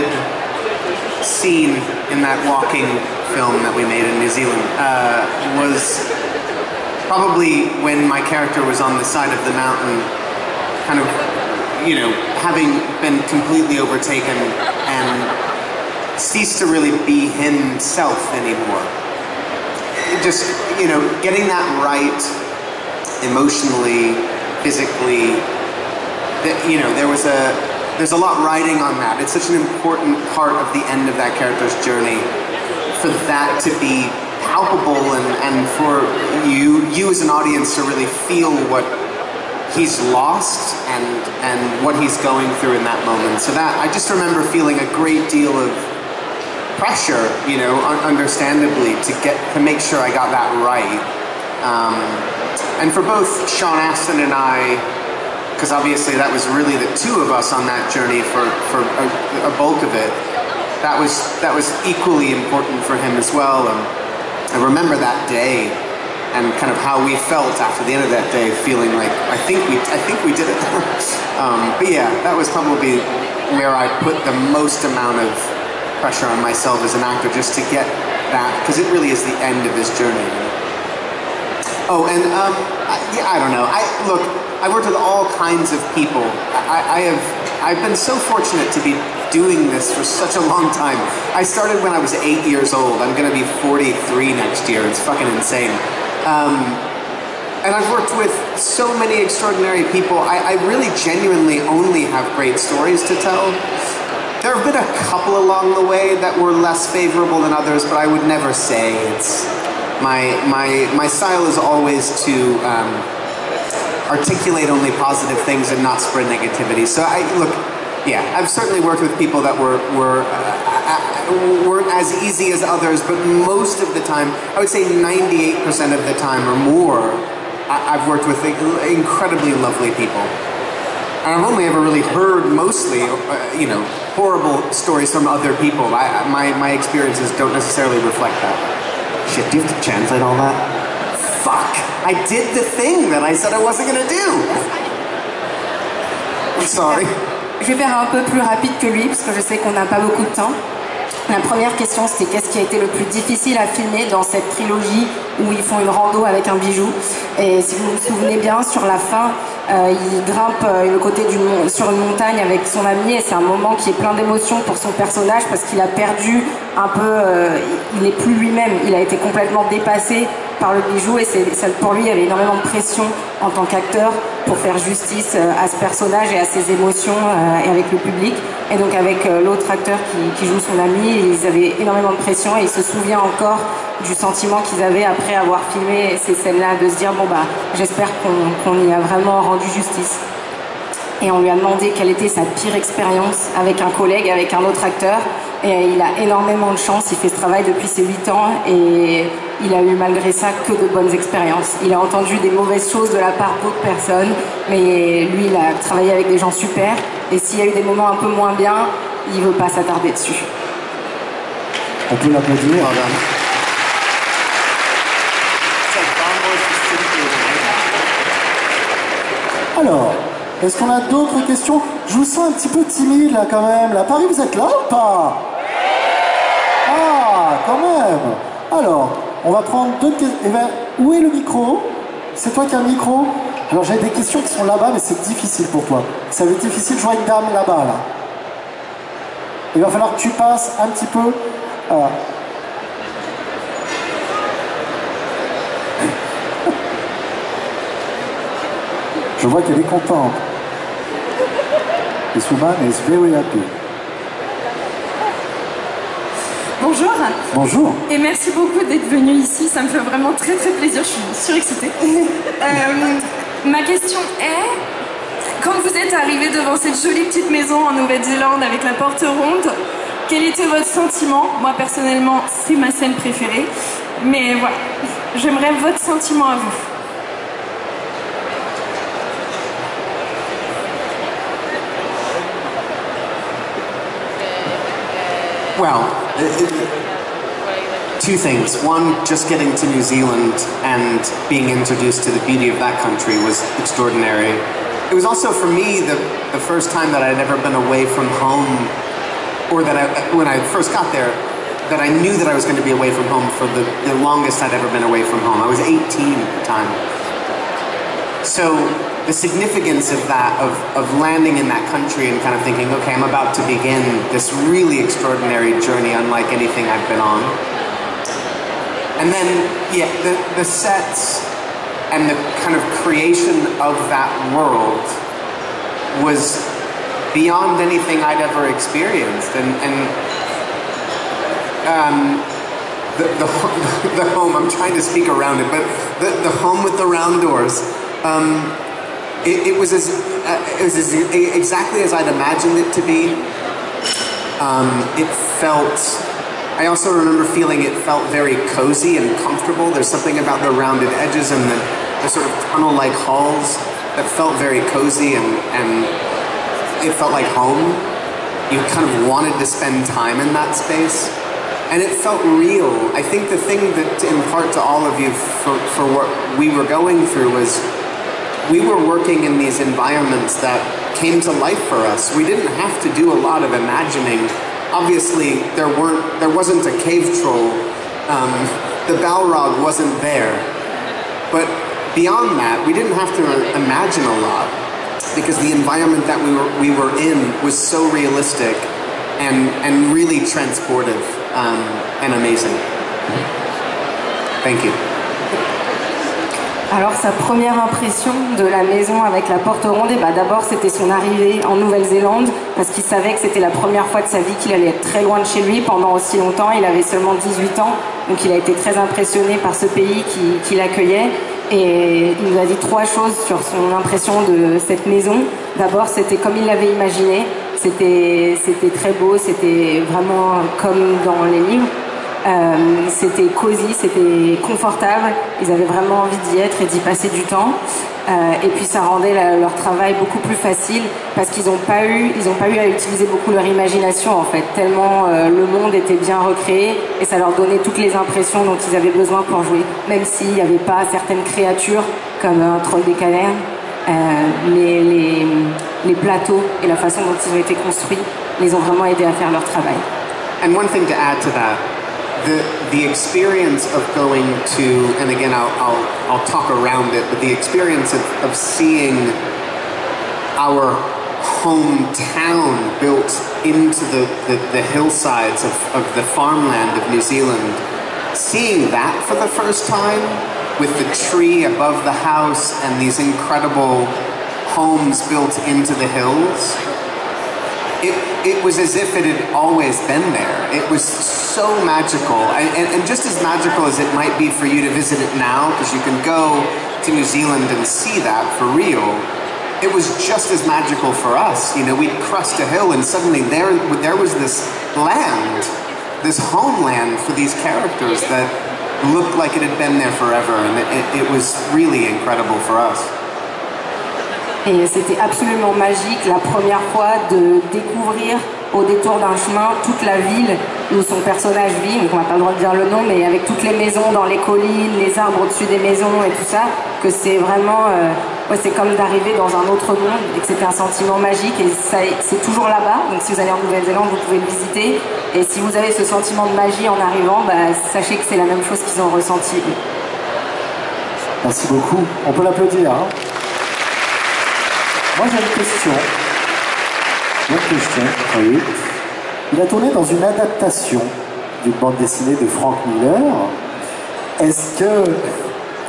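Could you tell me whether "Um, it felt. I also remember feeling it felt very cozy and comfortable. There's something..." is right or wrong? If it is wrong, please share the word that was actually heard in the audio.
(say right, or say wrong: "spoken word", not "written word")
right.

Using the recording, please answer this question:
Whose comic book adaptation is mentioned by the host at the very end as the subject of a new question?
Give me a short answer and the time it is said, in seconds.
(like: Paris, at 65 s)
Frank Miller, at 542 s.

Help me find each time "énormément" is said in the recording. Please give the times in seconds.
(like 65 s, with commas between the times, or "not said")
172 s, 181 s, 196 s.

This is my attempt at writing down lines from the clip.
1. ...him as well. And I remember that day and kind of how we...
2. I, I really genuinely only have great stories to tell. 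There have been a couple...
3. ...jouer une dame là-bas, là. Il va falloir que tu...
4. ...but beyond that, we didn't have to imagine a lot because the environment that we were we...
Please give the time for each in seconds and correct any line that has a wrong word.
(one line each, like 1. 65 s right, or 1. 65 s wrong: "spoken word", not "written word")
1. 62 s right
2. 100 s right
3. 237 s right
4. 381 s right.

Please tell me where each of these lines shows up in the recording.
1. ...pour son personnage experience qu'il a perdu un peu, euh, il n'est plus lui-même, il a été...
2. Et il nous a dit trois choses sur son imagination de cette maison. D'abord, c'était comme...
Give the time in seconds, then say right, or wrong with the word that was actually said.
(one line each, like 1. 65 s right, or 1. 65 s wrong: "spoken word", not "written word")
1. 164 s wrong: "parce", not "experience"
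2. 411 s wrong: "impression", not "imagination".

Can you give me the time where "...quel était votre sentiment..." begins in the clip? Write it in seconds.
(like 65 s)
270 s.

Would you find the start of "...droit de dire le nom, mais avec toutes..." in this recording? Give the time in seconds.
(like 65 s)
512 s.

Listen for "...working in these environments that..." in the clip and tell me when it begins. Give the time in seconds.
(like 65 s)
369 s.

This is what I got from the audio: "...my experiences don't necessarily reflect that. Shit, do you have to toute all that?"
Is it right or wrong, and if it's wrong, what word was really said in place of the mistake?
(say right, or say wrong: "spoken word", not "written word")
wrong: "translate", not "toute".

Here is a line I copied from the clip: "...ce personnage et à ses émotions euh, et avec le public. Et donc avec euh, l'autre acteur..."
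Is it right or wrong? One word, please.
right.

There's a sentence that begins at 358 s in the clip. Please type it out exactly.
You kind of wanted to spend time in that space and it felt real.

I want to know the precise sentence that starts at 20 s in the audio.
Just, you know, getting that right emotionally, physically, that, you know, there was a, there's a lot riding on that.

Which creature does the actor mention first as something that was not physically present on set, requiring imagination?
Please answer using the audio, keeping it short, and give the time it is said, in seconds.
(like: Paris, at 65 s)
cave troll, at 376 s.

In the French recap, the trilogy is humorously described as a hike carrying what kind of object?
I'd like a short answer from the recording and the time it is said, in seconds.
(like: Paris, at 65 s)
un bijou, at 156 s.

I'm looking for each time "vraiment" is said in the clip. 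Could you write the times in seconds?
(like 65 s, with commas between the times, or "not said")
188 s, 259 s, 420 s, 425 s, 448 s, 517 s.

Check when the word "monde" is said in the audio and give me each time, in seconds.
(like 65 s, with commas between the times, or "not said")
435 s, 519 s.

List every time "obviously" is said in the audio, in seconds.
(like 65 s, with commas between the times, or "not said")
55 s, 374 s.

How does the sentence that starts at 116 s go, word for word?
So I look, yeah, I've certainly worked with people that were were.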